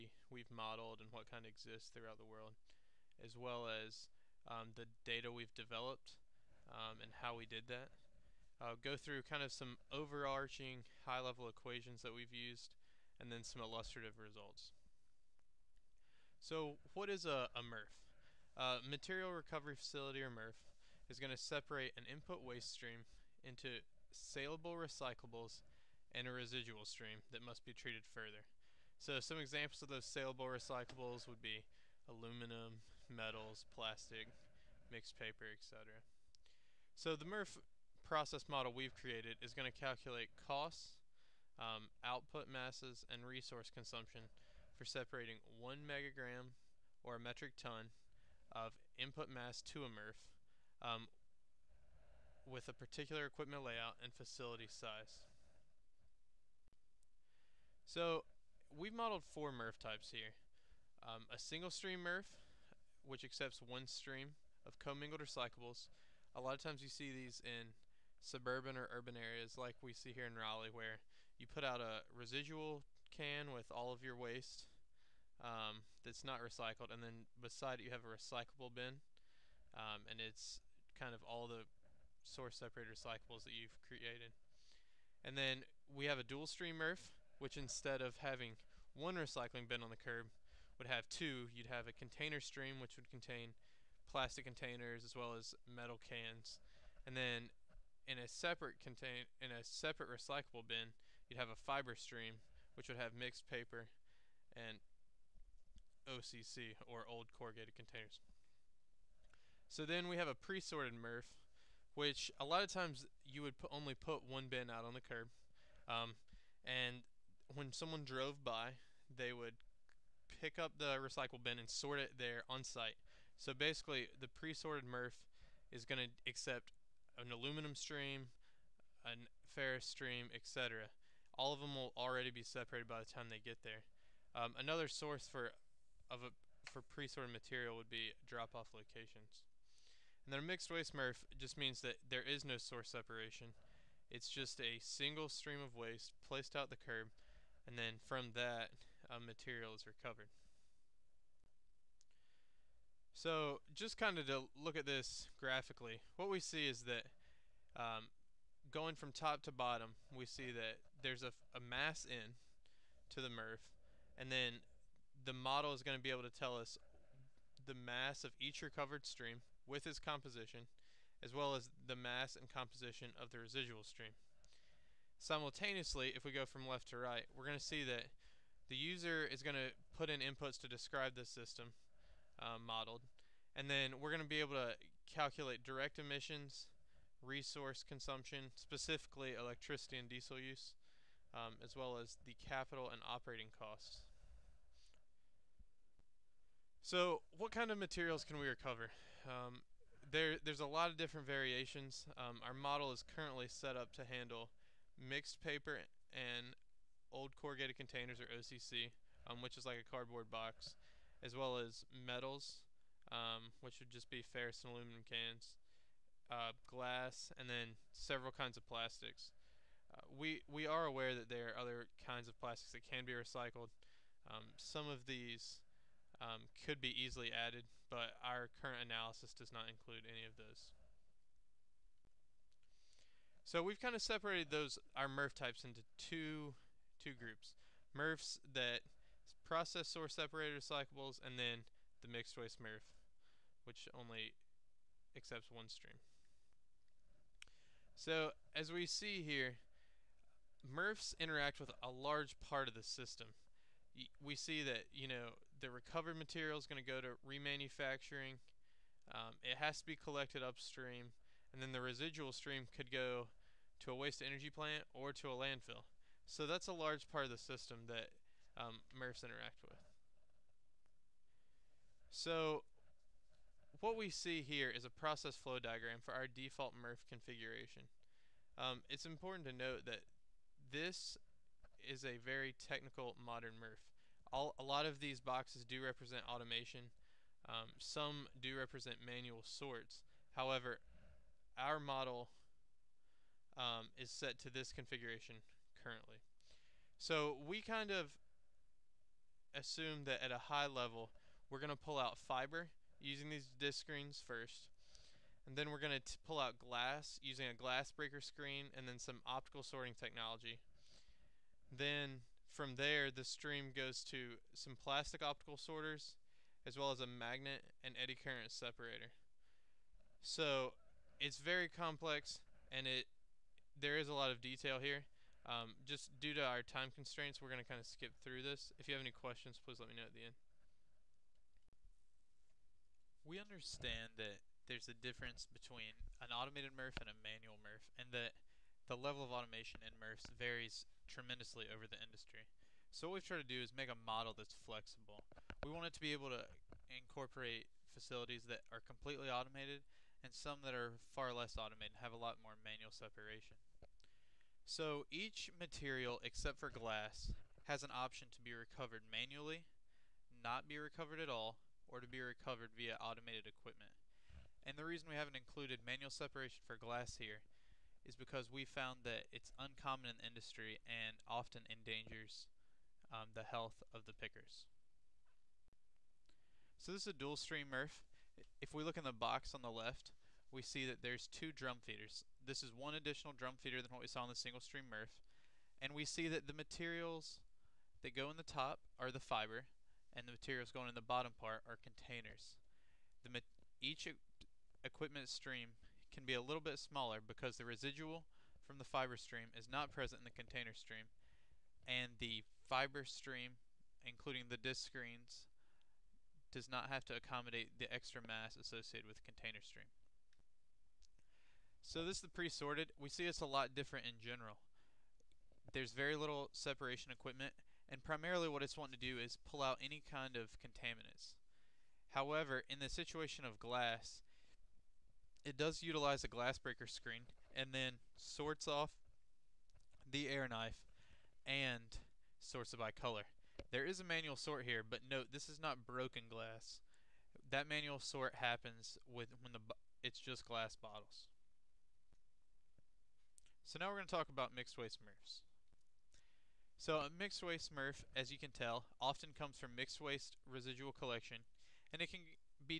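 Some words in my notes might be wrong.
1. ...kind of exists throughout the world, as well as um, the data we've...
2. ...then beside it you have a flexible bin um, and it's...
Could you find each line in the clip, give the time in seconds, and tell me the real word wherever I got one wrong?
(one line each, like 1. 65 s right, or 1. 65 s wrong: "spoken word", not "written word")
1. 1 s right
2. 77 s wrong: "recyclable", not "flexible".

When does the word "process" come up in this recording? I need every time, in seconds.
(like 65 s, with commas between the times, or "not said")
38 s, 239 s, 274 s.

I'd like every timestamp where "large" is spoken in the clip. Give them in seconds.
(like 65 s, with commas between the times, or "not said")
251 s, 266 s.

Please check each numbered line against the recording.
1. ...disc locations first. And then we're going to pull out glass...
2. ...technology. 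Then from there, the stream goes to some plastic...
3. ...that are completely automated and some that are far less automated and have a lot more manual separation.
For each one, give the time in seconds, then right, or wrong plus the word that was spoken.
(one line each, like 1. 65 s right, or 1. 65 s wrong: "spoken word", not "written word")
1. 303 s wrong: "screens", not "locations"
2. 309 s right
3. 348 s right.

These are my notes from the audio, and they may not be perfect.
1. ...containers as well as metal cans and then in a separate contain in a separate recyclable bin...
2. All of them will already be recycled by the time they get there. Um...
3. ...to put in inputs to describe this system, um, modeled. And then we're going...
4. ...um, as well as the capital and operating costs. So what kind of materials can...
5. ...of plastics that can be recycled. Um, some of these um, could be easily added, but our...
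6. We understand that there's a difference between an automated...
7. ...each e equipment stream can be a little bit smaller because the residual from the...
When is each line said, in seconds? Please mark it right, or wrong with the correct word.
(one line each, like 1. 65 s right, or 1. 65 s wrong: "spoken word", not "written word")
1. 94 s right
2. 131 s wrong: "separated", not "recycled"
3. 179 s right
4. 191 s right
5. 222 s right
6. 333 s right
7. 393 s right.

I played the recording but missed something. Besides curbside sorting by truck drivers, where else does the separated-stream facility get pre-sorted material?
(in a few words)
Drop-off locations.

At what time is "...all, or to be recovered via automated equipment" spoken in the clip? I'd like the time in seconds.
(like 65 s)
361 s.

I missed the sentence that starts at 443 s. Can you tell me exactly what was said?
So now we're going to talk about mixed waste MRFs.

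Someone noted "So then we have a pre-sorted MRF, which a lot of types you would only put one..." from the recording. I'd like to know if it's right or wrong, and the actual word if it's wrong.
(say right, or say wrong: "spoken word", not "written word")
wrong: "times", not "types".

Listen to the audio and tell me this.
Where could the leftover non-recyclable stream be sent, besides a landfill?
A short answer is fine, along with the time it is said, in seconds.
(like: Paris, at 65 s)
Waste energy plant, at 263 s.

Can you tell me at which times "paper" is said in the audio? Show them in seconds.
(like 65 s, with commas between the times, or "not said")
35 s, 103 s, 205 s.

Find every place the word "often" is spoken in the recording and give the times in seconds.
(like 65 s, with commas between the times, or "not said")
371 s, 449 s.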